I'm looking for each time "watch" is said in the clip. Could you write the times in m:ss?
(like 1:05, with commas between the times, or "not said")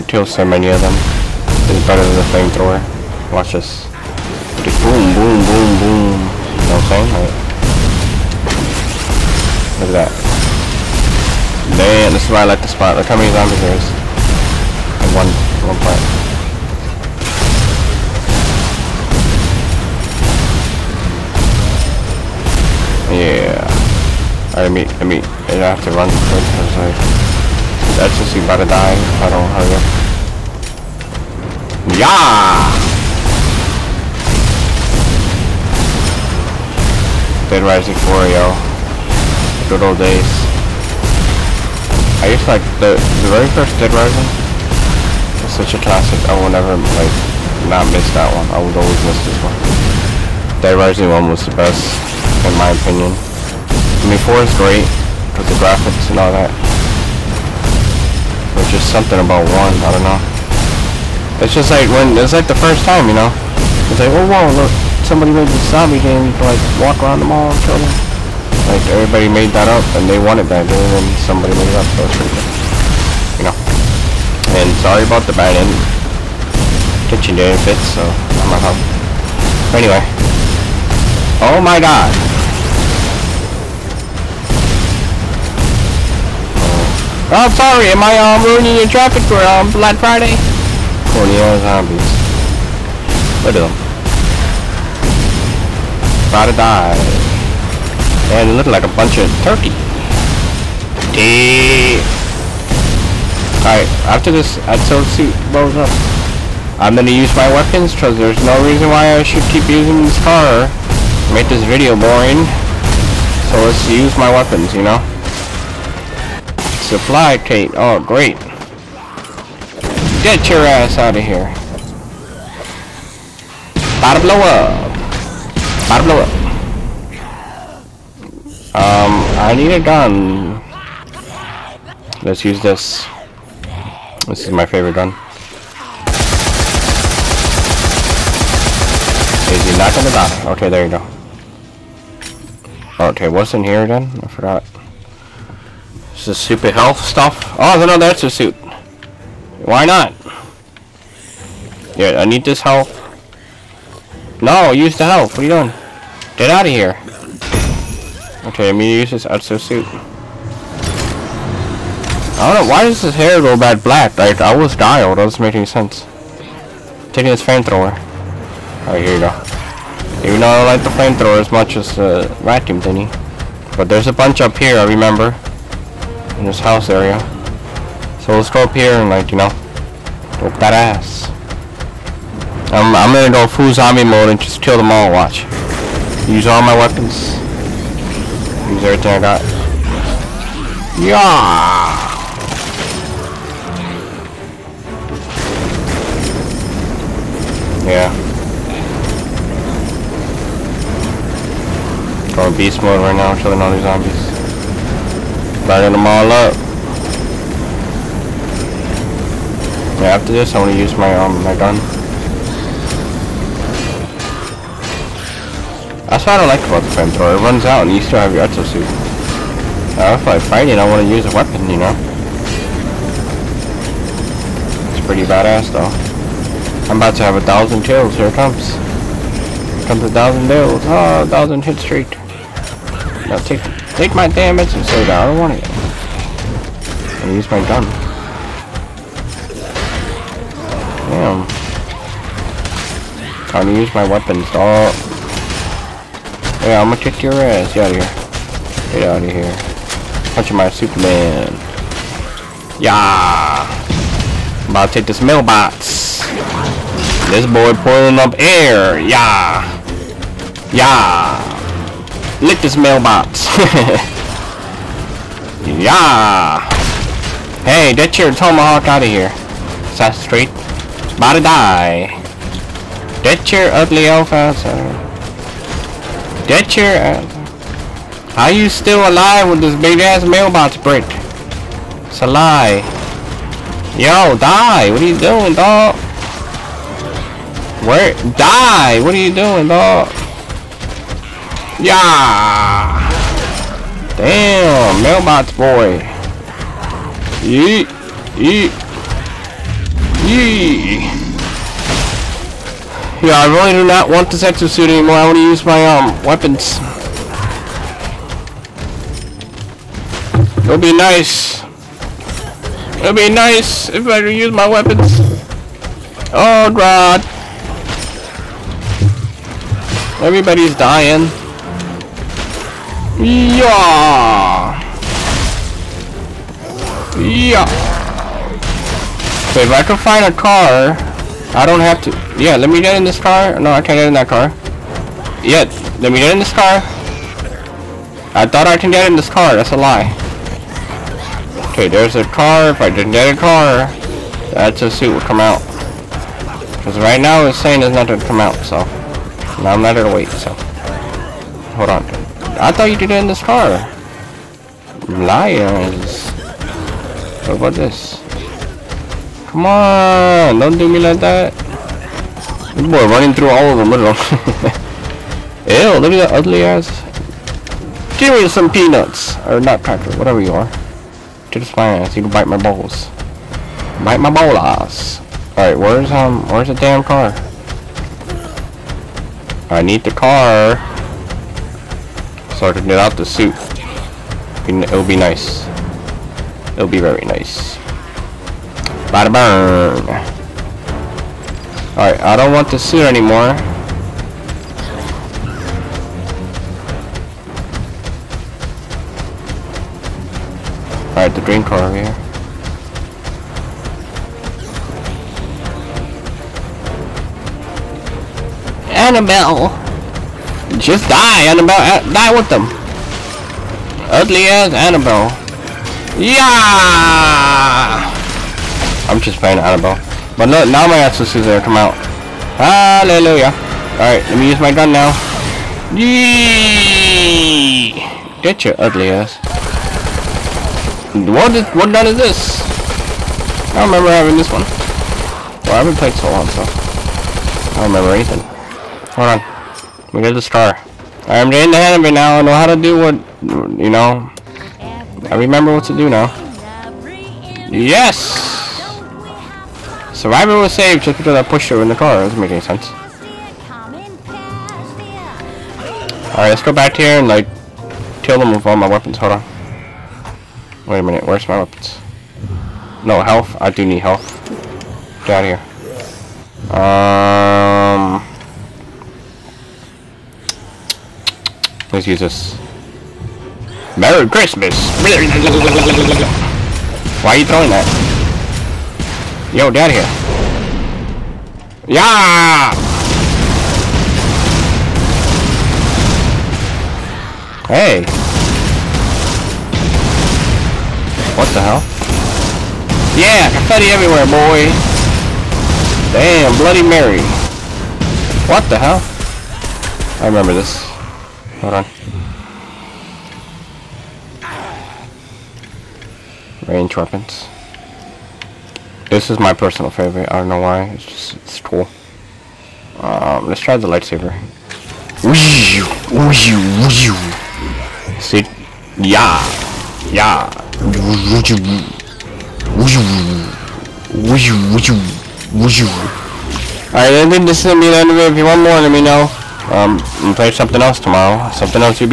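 0:03, 3:05.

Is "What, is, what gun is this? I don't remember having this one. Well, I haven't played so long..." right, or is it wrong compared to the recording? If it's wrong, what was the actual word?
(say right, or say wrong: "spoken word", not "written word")
right.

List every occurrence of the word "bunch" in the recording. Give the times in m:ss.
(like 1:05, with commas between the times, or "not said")
1:38, 2:54.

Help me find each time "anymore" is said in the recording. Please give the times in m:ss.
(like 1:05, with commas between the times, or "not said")
5:04, 6:33.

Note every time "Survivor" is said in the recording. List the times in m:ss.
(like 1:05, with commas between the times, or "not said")
7:30.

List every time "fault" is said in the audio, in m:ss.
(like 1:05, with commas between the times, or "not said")
1:18.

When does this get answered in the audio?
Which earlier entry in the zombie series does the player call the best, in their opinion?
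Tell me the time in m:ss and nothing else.
0:50.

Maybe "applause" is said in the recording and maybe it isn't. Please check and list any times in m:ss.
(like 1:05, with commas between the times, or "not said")
not said.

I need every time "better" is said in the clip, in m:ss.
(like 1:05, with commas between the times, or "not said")
0:01.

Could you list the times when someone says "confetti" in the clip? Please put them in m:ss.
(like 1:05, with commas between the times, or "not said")
8:13.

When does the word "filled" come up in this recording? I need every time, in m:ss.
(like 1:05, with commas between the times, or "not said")
not said.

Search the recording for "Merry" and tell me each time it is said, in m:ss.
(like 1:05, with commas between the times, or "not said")
7:53.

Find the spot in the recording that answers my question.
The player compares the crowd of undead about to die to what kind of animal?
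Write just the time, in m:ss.
1:39.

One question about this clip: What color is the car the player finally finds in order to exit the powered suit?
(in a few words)
green.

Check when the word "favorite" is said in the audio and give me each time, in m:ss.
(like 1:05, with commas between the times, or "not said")
2:14, 8:29.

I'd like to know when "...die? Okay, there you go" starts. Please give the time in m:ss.
2:20.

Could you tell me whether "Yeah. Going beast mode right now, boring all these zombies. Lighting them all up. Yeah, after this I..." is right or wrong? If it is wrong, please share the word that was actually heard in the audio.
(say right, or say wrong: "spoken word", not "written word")
wrong: "killing", not "boring".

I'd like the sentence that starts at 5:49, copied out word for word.
Now I'm not gonna wait, so.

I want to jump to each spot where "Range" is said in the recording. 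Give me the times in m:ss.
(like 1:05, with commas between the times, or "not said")
8:26.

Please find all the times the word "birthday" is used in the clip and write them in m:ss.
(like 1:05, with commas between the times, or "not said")
not said.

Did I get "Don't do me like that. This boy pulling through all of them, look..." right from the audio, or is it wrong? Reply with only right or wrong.
wrong.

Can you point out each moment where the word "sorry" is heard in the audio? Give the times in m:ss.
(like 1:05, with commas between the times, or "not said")
1:14, 1:27.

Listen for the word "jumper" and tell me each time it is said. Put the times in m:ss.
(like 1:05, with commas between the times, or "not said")
not said.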